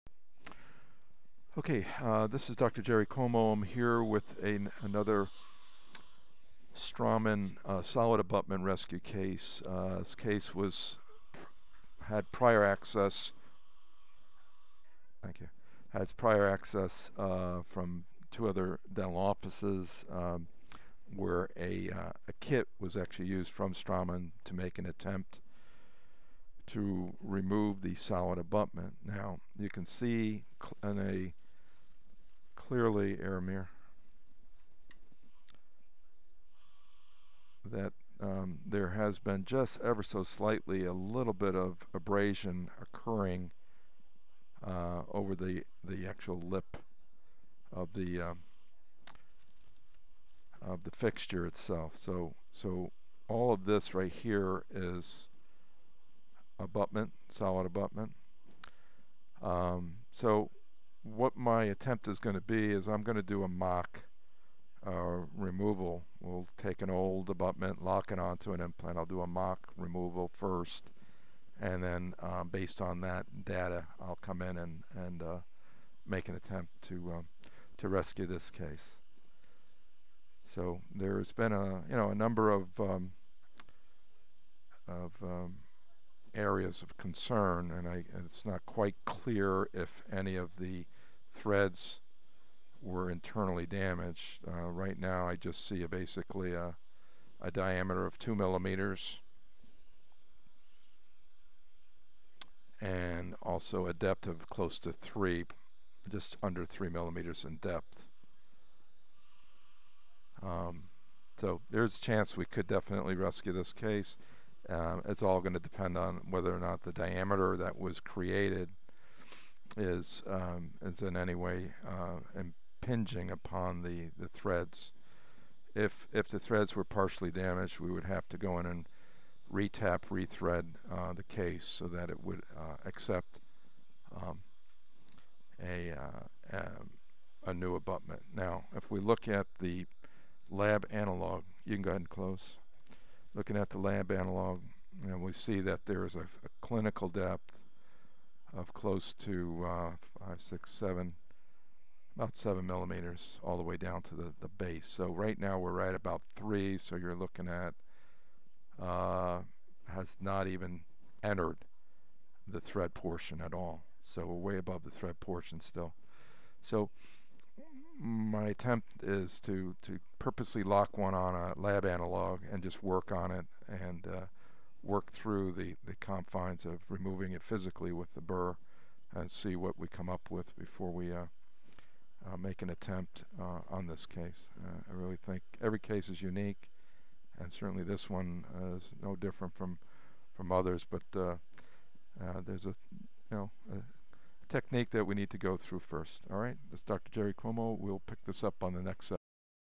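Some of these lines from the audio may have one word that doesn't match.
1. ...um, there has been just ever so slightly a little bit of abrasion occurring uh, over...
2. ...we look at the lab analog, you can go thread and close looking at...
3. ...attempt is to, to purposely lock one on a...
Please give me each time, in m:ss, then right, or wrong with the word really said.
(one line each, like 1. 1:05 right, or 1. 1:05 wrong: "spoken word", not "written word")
1. 0:38 right
2. 2:18 wrong: "ahead", not "thread"
3. 2:48 right.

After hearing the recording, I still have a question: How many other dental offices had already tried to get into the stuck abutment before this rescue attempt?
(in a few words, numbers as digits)
2.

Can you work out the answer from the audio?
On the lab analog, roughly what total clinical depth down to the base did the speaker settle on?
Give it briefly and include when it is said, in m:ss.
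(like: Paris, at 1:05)
About 7 millimeters, at 2:32.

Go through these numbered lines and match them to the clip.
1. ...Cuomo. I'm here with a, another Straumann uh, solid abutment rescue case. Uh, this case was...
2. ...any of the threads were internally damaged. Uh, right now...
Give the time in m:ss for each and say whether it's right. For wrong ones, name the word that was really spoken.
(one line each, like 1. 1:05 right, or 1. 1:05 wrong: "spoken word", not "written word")
1. 0:03 right
2. 1:30 right.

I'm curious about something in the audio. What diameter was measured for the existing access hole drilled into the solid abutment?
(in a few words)
2 millimeters.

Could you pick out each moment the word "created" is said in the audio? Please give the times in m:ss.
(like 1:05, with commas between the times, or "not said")
1:57.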